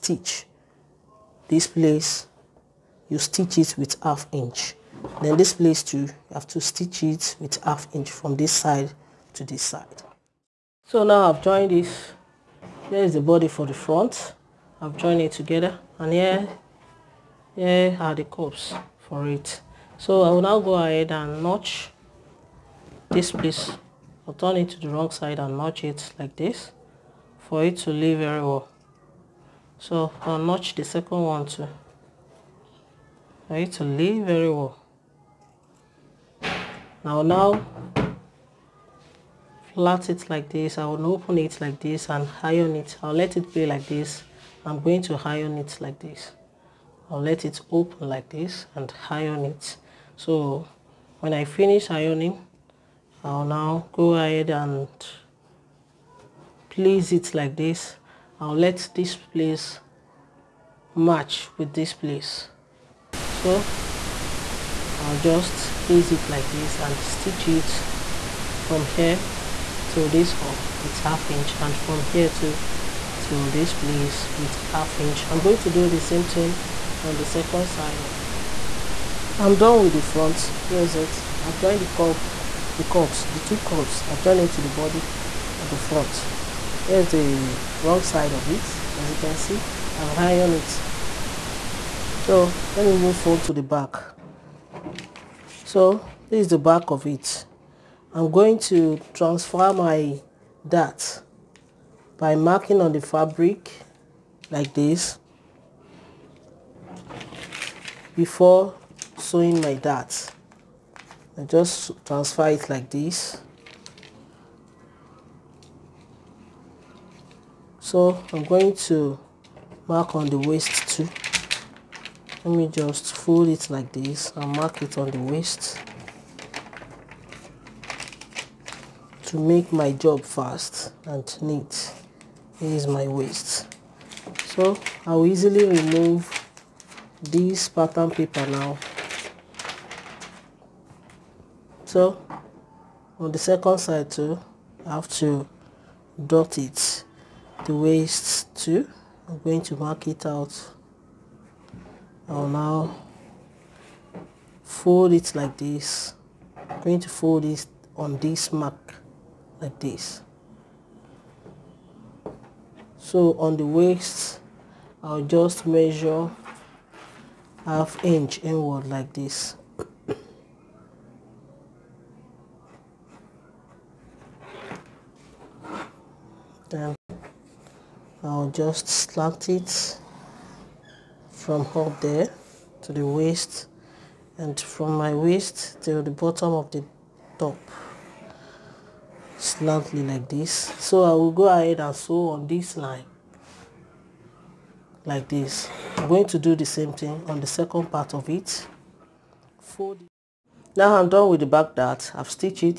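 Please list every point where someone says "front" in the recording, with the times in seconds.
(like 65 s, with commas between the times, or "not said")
13 s, 80 s, 85 s.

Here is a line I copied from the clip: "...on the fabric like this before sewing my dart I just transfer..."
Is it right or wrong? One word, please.
right.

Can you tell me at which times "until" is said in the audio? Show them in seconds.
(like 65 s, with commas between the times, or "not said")
not said.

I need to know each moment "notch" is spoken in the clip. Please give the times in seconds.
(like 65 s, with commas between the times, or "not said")
21 s, 25 s, 30 s.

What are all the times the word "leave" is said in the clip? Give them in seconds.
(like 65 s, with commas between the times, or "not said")
27 s, 33 s.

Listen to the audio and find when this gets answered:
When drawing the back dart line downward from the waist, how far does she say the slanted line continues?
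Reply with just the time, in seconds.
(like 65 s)
186 s.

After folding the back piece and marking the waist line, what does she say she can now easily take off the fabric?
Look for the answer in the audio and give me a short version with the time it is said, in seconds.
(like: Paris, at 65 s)
Pattern paper, at 137 s.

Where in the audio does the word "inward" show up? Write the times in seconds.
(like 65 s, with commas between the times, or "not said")
168 s.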